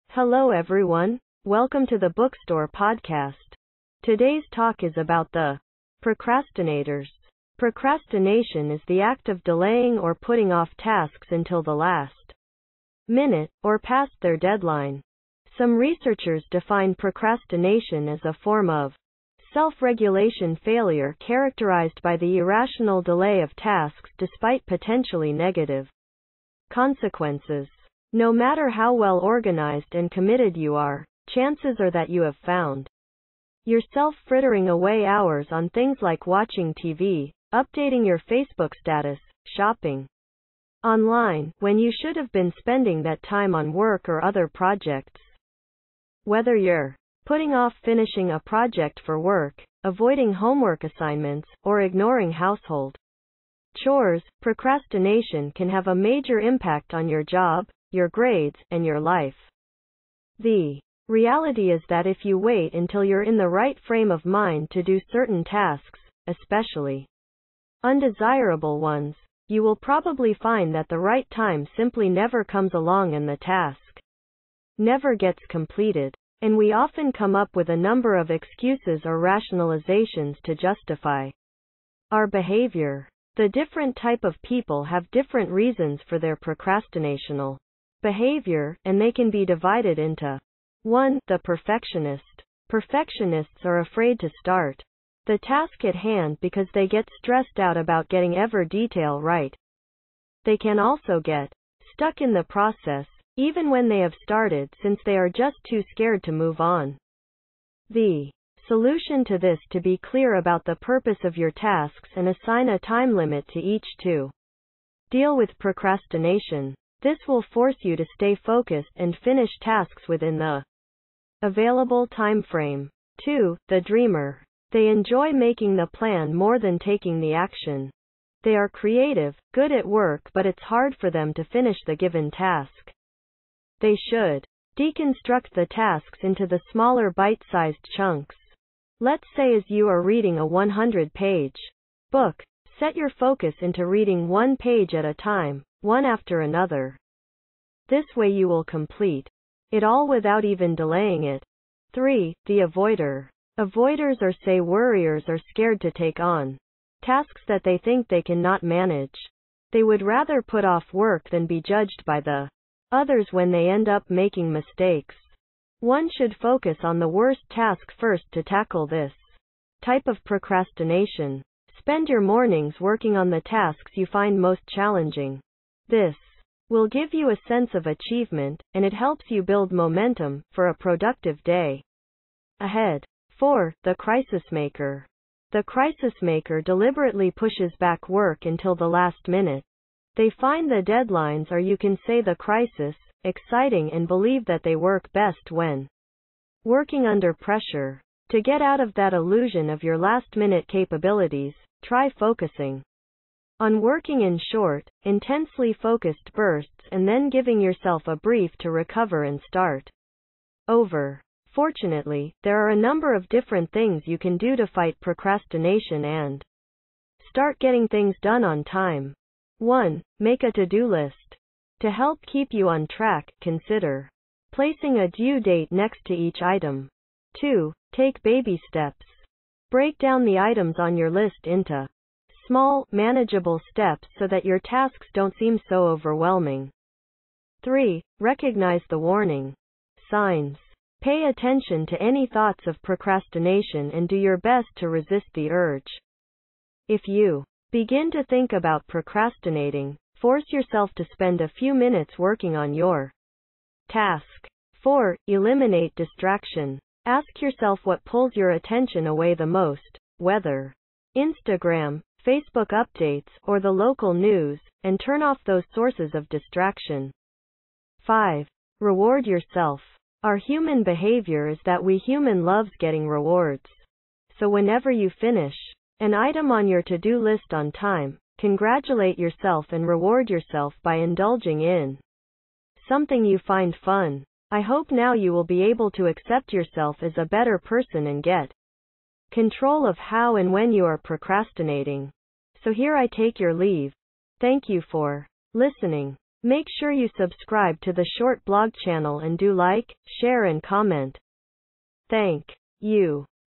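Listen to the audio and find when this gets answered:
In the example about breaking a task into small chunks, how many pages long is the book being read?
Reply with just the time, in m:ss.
2:20.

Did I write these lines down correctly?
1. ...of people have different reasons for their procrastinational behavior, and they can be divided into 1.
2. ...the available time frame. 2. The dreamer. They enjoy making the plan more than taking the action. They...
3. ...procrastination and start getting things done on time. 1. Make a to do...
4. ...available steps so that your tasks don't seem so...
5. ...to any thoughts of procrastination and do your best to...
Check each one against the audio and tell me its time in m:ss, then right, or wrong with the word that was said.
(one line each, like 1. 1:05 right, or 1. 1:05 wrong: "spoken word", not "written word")
1. 1:24 right
2. 2:00 right
3. 3:34 right
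4. 3:52 wrong: "manageable", not "available"
5. 4:01 right.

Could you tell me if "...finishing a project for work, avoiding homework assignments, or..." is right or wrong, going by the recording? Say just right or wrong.
right.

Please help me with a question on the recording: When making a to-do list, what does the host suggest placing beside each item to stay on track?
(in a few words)
A due date.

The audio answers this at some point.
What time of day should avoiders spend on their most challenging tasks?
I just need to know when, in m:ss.
2:52.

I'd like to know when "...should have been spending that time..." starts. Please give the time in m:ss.
0:41.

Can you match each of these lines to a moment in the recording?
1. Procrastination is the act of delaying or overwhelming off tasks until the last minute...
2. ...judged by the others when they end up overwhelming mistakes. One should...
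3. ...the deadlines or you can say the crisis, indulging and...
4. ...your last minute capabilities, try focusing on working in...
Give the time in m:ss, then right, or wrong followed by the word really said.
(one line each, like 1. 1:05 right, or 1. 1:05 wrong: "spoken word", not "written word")
1. 0:07 wrong: "putting", not "overwhelming"
2. 2:41 wrong: "making", not "overwhelming"
3. 3:10 wrong: "exciting", not "indulging"
4. 3:19 right.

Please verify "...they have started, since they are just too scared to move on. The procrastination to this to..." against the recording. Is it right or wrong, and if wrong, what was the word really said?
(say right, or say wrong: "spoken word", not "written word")
wrong: "solution", not "procrastination".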